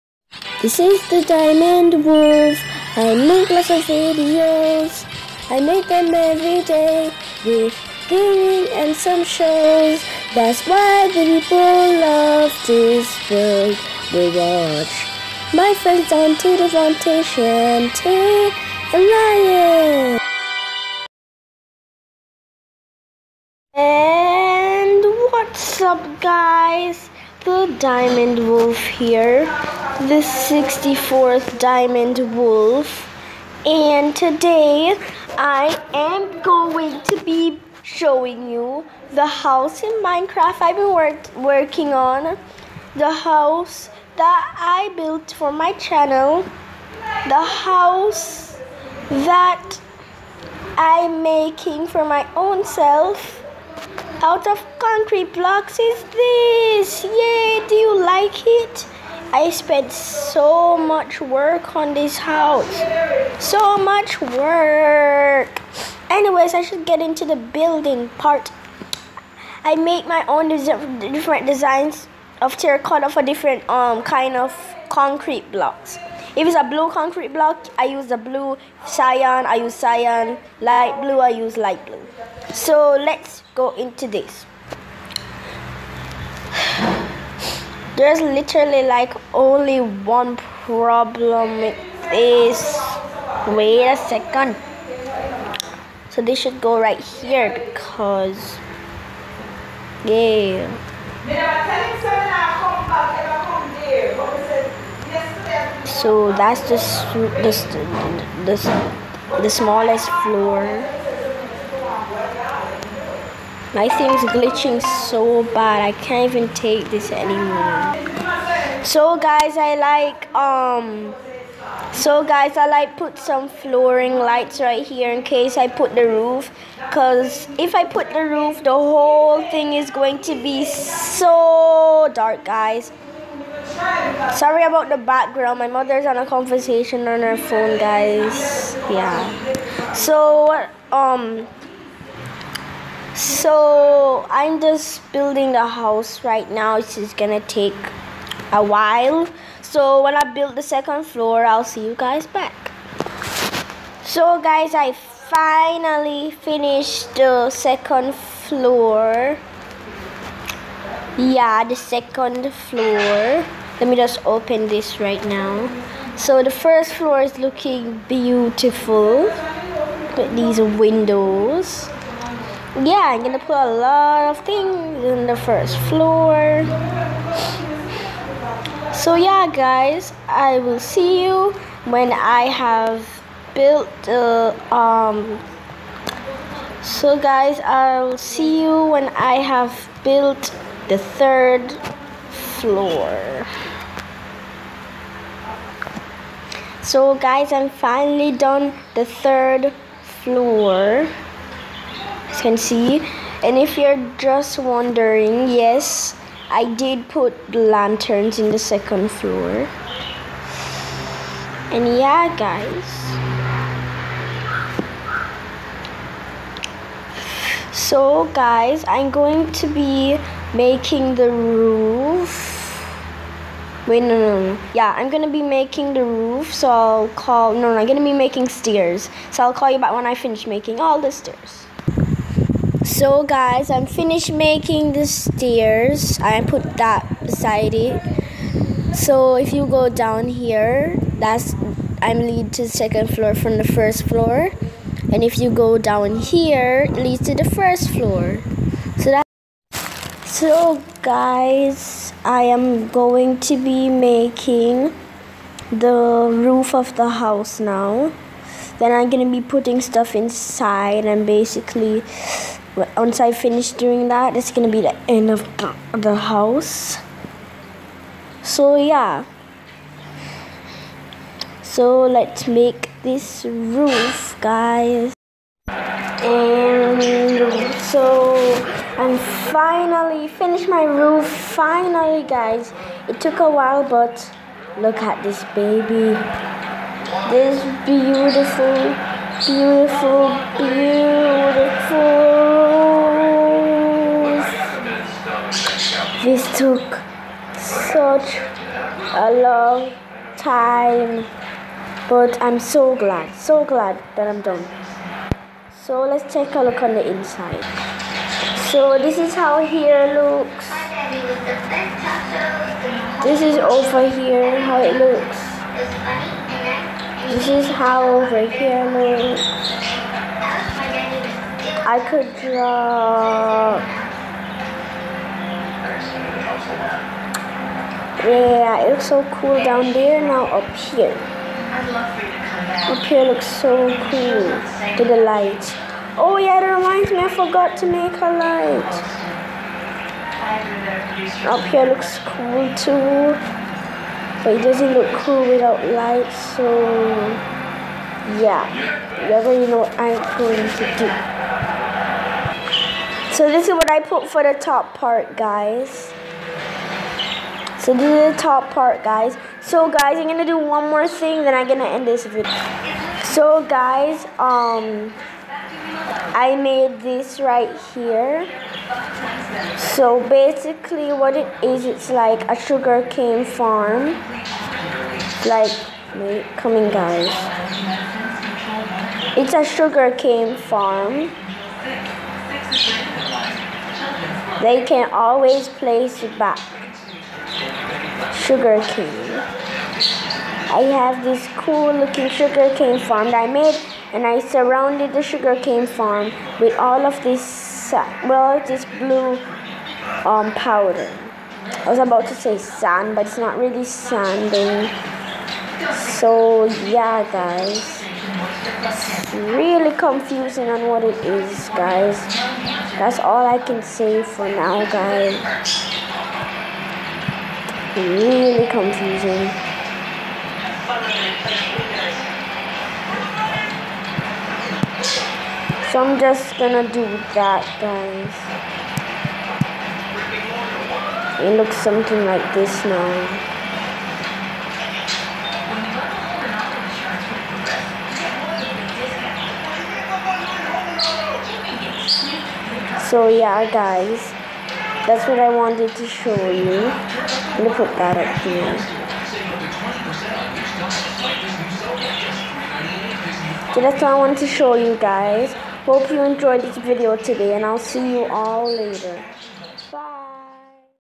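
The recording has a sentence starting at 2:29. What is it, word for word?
So when I build the second floor, I'll see you guys back.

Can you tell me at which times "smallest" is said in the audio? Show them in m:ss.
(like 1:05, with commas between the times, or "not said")
1:49.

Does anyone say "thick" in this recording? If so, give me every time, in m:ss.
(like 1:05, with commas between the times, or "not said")
not said.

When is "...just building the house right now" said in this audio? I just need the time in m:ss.
2:24.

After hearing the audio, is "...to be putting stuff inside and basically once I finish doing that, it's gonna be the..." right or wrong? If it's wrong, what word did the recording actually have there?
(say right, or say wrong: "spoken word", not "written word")
right.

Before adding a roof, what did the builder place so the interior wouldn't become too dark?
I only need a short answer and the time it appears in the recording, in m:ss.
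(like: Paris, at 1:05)
Flooring lights, at 2:03.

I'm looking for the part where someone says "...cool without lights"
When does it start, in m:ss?
5:45.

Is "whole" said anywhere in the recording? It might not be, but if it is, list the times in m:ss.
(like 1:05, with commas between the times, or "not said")
2:08.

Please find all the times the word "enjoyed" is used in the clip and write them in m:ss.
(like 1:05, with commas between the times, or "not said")
7:36.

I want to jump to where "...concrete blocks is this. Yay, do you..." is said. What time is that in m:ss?
0:54.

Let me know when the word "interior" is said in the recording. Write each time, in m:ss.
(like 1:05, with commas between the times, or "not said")
not said.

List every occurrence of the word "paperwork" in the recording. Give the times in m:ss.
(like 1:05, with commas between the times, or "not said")
not said.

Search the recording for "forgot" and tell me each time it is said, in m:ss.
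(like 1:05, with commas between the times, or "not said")
5:37.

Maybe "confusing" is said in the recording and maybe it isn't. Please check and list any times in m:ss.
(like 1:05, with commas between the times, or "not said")
6:49, 6:58.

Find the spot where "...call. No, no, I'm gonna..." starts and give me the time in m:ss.
3:47.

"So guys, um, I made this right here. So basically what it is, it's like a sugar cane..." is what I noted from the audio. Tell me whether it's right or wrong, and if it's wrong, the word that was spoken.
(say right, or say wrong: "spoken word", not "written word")
right.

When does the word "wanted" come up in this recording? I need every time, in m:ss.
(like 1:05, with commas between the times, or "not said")
7:25, 7:34.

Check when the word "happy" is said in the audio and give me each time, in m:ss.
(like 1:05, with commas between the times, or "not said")
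not said.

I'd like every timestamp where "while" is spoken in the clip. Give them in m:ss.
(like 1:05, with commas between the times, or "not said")
2:28, 4:43.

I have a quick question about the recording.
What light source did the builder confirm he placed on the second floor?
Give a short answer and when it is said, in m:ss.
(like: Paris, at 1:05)
Lanterns, at 3:27.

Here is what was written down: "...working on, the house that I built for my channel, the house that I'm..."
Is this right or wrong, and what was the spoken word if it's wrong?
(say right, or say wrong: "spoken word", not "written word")
right.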